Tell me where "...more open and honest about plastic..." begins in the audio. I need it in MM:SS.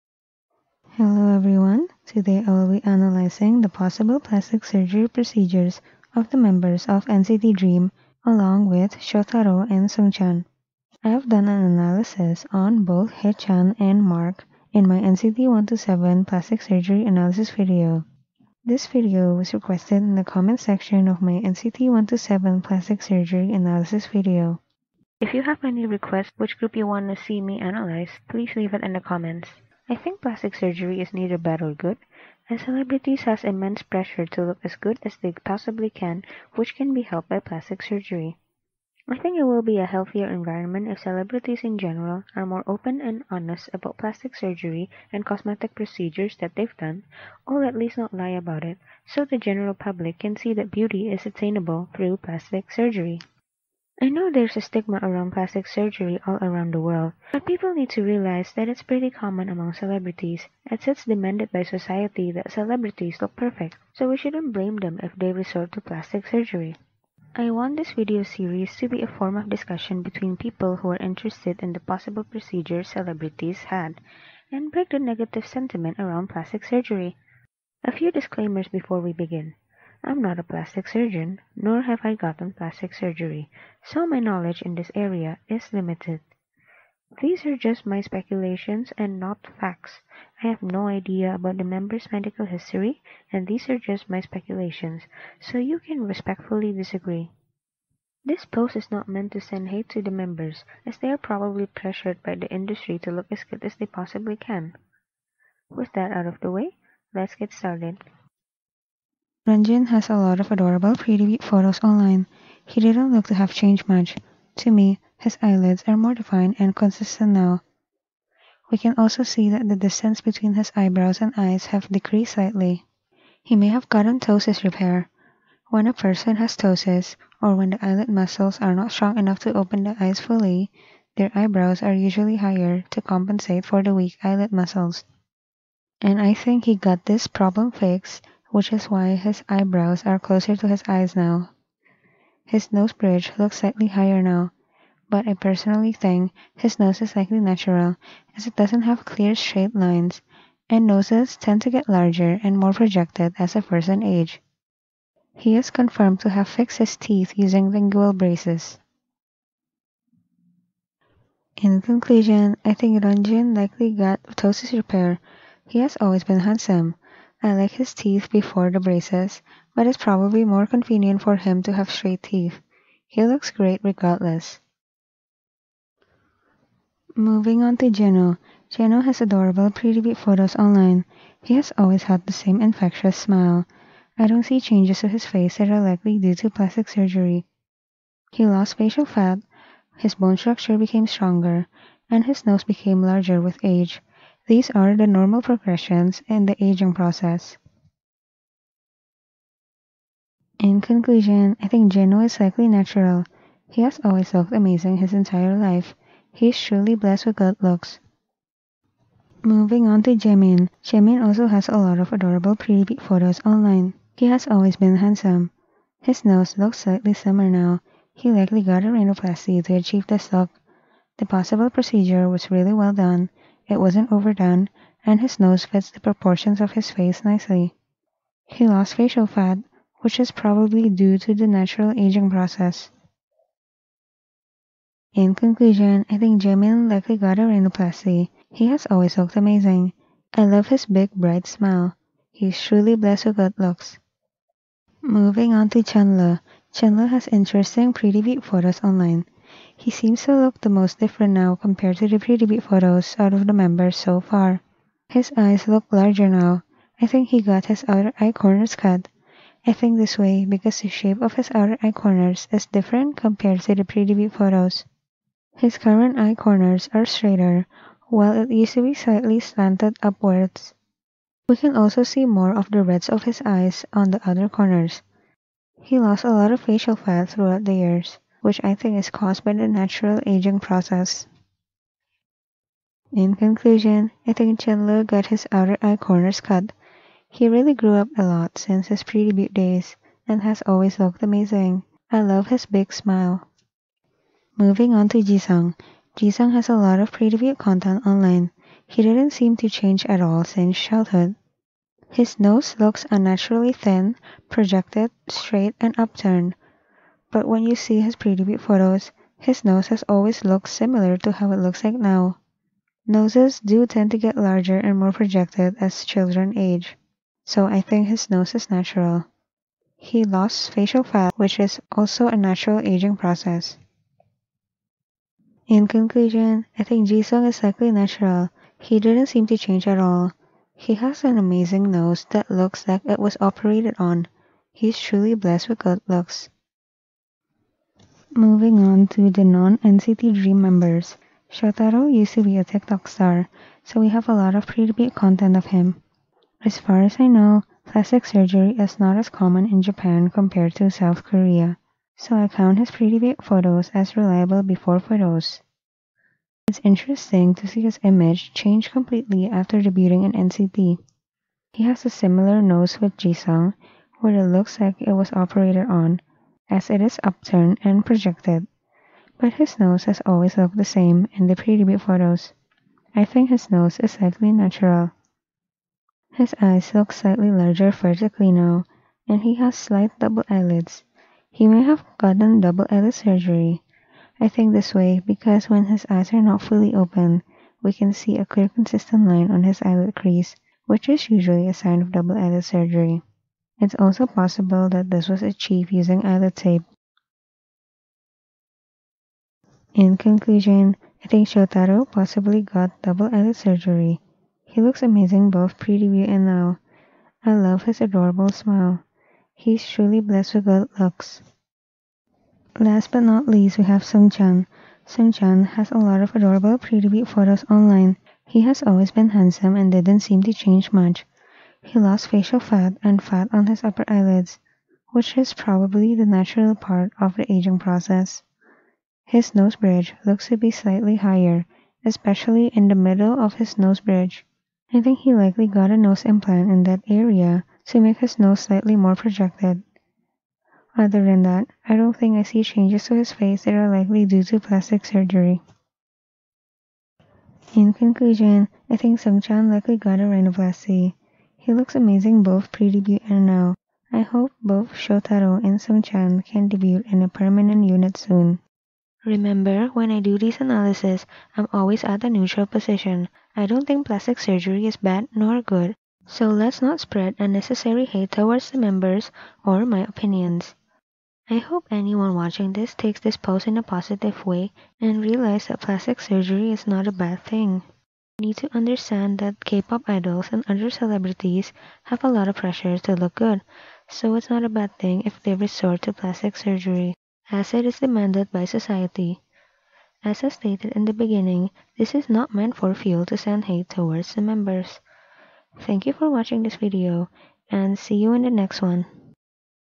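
00:42.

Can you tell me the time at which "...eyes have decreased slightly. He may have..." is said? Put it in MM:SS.
02:01.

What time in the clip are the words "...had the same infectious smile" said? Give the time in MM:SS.
03:02.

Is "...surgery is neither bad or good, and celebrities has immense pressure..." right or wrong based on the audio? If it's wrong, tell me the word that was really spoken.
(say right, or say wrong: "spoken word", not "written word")
right.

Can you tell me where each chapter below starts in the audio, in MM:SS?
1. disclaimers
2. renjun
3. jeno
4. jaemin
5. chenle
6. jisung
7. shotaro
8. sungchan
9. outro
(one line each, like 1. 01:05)
1. 01:17
2. 01:49
3. 02:56
4. 03:29
5. 04:05
6. 04:54
7. 05:37
8. 06:52
9. 07:39.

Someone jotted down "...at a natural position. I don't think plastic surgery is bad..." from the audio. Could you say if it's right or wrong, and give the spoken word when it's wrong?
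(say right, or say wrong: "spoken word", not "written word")
wrong: "neutral", not "natural".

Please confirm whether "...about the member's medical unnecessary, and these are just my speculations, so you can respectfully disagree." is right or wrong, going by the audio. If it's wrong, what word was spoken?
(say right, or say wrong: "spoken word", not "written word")
wrong: "history", not "unnecessary".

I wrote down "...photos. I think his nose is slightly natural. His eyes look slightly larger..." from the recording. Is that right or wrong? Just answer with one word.
right.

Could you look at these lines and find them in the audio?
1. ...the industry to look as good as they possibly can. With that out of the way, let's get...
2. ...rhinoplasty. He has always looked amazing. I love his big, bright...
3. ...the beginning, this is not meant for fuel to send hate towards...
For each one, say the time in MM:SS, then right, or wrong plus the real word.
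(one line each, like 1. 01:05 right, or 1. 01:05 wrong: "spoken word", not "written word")
1. 01:42 right
2. 03:57 right
3. 08:11 right.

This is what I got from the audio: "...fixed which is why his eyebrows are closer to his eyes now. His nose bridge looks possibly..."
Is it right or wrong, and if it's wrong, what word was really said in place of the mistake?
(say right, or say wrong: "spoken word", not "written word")
wrong: "slightly", not "possibly".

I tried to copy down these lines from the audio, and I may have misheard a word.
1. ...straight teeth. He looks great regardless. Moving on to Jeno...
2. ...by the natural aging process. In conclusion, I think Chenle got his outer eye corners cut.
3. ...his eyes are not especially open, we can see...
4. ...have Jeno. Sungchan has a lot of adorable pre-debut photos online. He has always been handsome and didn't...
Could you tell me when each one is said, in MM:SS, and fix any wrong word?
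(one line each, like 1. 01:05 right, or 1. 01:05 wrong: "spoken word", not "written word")
1. 02:51 right
2. 04:39 right
3. 06:25 wrong: "fully", not "especially"
4. 06:53 wrong: "Sungchan", not "Jeno".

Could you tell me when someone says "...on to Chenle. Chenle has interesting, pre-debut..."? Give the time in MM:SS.
04:05.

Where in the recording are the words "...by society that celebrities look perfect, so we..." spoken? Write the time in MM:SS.
01:01.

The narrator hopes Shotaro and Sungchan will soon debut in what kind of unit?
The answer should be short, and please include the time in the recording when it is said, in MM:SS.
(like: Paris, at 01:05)
permanent unit, at 07:37.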